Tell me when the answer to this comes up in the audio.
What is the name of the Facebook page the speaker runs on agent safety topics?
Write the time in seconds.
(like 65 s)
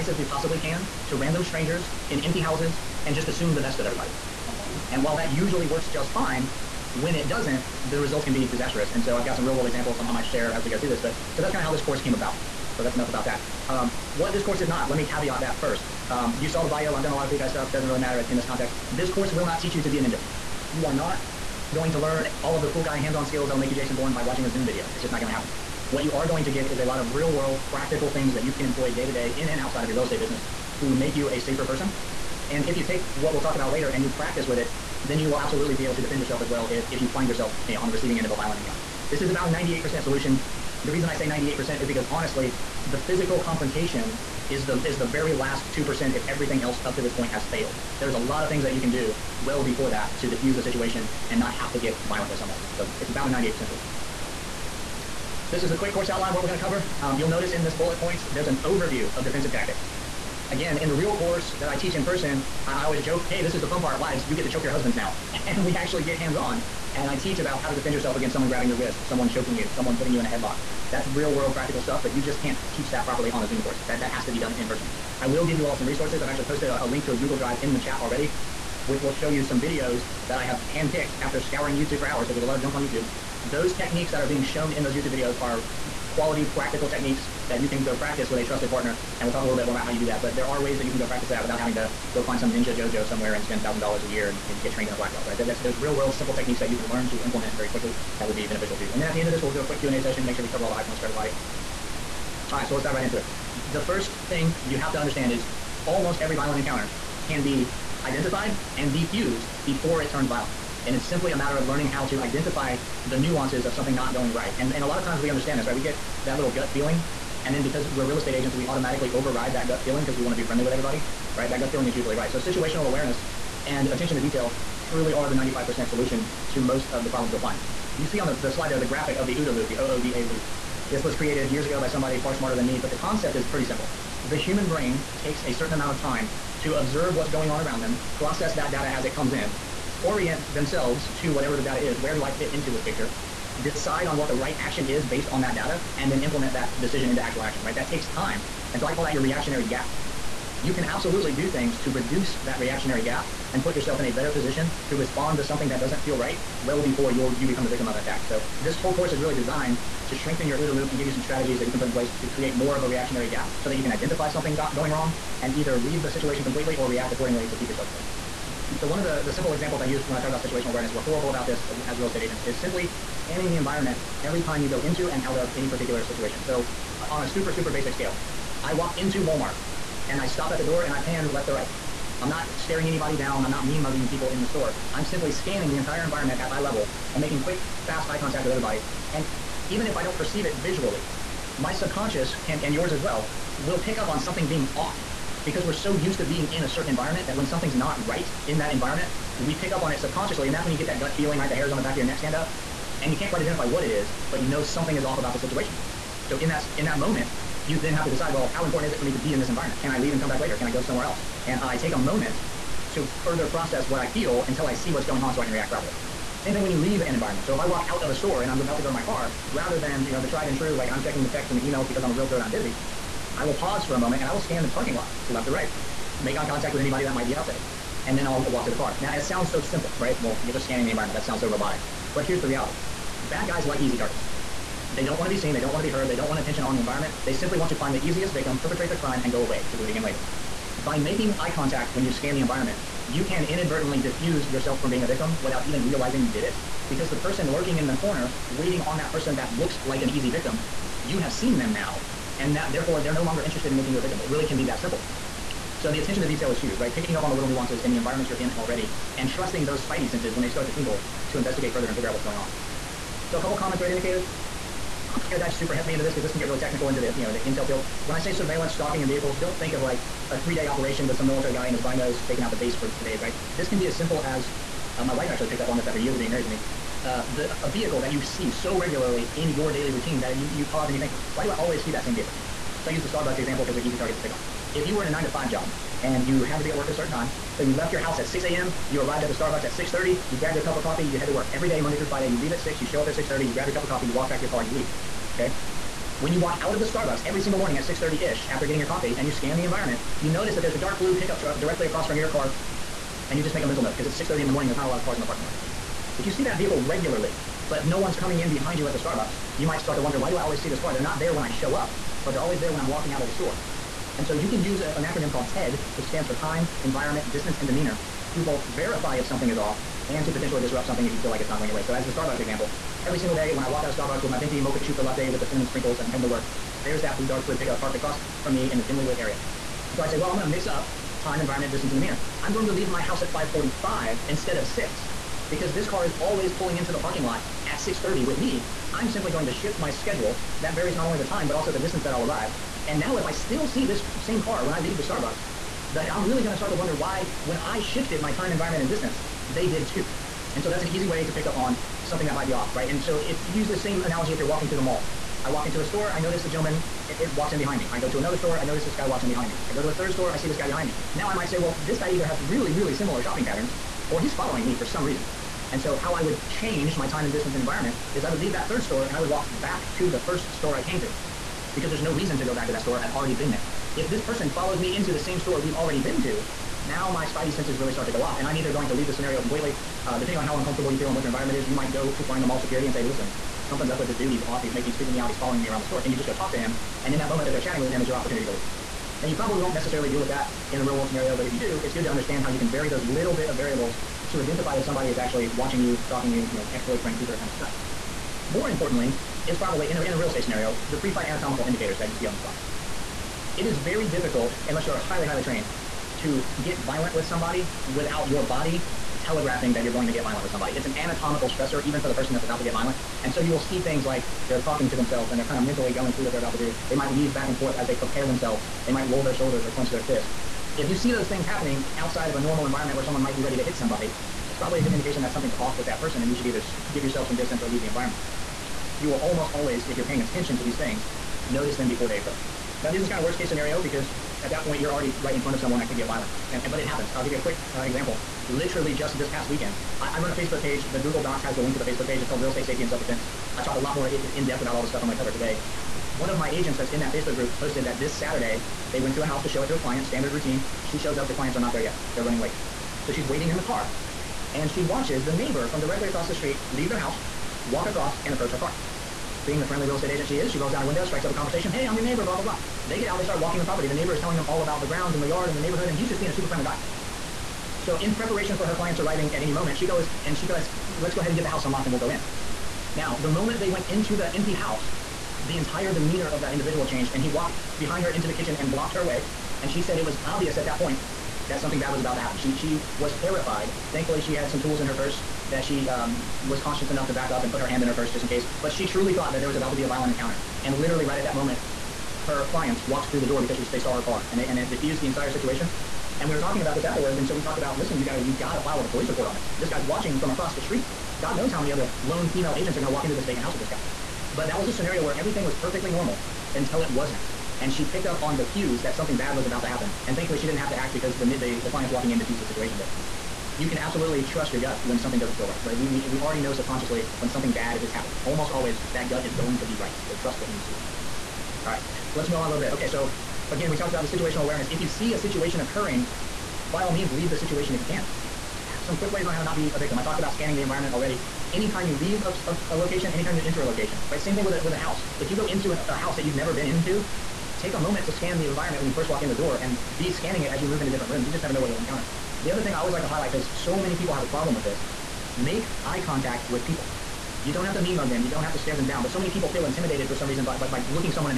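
442 s.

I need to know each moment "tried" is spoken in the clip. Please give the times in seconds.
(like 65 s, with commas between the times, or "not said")
220 s.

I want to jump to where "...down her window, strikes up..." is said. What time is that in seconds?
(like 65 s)
460 s.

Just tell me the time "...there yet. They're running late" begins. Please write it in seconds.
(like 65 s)
451 s.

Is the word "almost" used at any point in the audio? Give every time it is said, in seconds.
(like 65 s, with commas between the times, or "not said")
105 s, 429 s, 518 s.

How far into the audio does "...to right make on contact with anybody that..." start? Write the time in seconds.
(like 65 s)
225 s.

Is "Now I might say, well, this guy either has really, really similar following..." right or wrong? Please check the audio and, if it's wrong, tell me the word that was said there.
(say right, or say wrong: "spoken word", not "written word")
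wrong: "shopping", not "following".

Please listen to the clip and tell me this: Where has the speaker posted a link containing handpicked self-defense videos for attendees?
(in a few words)
Google Drive.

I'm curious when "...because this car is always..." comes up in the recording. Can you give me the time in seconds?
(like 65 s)
335 s.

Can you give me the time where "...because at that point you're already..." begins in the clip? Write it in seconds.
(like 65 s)
433 s.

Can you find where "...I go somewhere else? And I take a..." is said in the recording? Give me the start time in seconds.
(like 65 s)
210 s.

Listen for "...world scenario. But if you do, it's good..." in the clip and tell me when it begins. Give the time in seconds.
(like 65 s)
390 s.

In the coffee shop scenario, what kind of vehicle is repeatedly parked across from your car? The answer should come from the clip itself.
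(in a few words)
dark blue pickup truck.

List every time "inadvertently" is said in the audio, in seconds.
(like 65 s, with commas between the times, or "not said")
243 s.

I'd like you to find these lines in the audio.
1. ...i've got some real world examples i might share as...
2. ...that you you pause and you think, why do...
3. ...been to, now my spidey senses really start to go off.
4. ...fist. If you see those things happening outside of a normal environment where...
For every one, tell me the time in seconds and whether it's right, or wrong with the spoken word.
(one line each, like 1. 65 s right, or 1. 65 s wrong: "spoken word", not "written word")
1. 9 s right
2. 280 s right
3. 375 s right
4. 420 s right.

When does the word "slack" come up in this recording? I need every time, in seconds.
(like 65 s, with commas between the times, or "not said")
not said.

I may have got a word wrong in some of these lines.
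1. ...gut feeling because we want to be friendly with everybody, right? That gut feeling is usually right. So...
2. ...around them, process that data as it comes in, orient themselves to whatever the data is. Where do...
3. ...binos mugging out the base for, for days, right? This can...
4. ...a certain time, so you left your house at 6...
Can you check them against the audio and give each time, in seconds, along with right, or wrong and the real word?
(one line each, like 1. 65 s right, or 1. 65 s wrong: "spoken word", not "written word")
1. 119 s right
2. 137 s right
3. 271 s wrong: "staking", not "mugging"
4. 286 s right.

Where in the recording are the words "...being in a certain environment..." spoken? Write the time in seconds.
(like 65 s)
196 s.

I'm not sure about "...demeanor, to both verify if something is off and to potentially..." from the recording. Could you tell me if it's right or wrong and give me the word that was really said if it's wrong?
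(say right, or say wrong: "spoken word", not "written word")
right.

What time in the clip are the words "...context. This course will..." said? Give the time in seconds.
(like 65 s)
18 s.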